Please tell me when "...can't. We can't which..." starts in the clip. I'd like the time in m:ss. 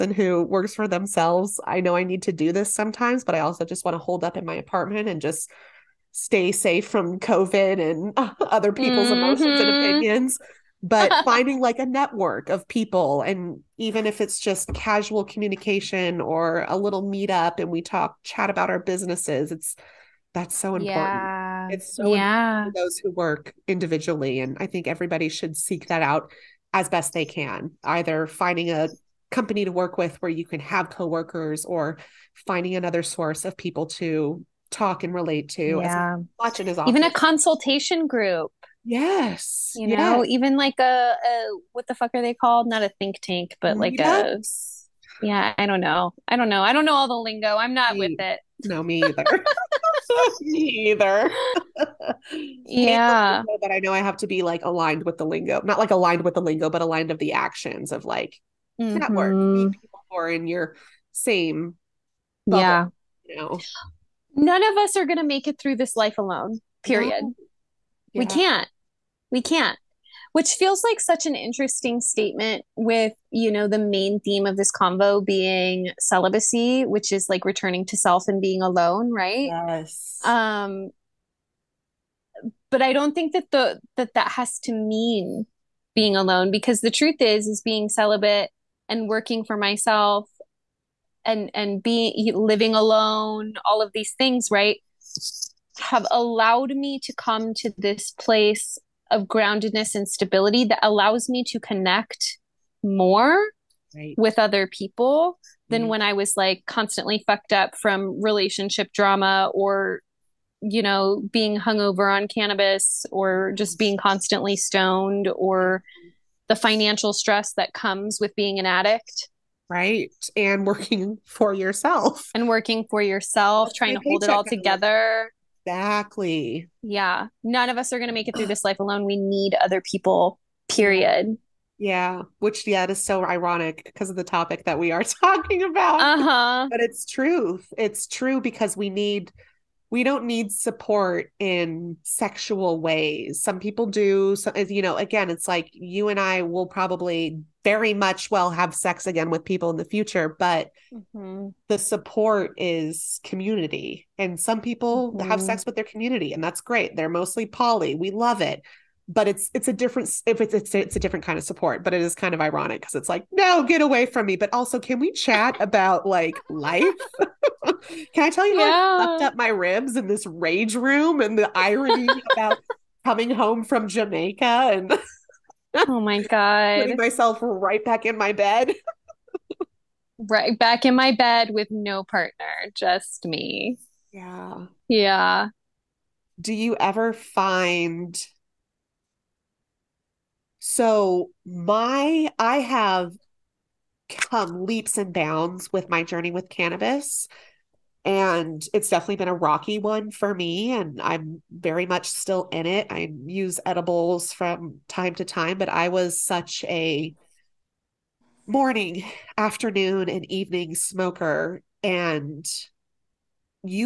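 1:08.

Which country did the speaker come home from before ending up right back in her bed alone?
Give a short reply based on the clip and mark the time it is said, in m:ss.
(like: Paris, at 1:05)
Jamaica, at 2:53.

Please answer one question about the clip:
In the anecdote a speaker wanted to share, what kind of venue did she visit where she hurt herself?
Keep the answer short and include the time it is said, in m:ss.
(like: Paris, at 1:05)
rage room, at 2:50.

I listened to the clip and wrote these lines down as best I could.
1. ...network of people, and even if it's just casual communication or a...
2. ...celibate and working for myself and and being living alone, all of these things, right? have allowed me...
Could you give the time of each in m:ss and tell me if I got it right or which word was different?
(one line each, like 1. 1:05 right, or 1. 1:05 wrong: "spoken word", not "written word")
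1. 0:11 right
2. 1:27 right.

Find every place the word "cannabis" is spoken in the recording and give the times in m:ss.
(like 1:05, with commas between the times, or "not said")
1:52, 3:16.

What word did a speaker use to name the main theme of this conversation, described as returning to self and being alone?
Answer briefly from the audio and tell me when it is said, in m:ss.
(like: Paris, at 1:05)
celibacy, at 1:15.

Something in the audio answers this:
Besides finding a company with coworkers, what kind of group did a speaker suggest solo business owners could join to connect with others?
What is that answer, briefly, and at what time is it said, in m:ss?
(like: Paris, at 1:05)
consultation group, at 0:37.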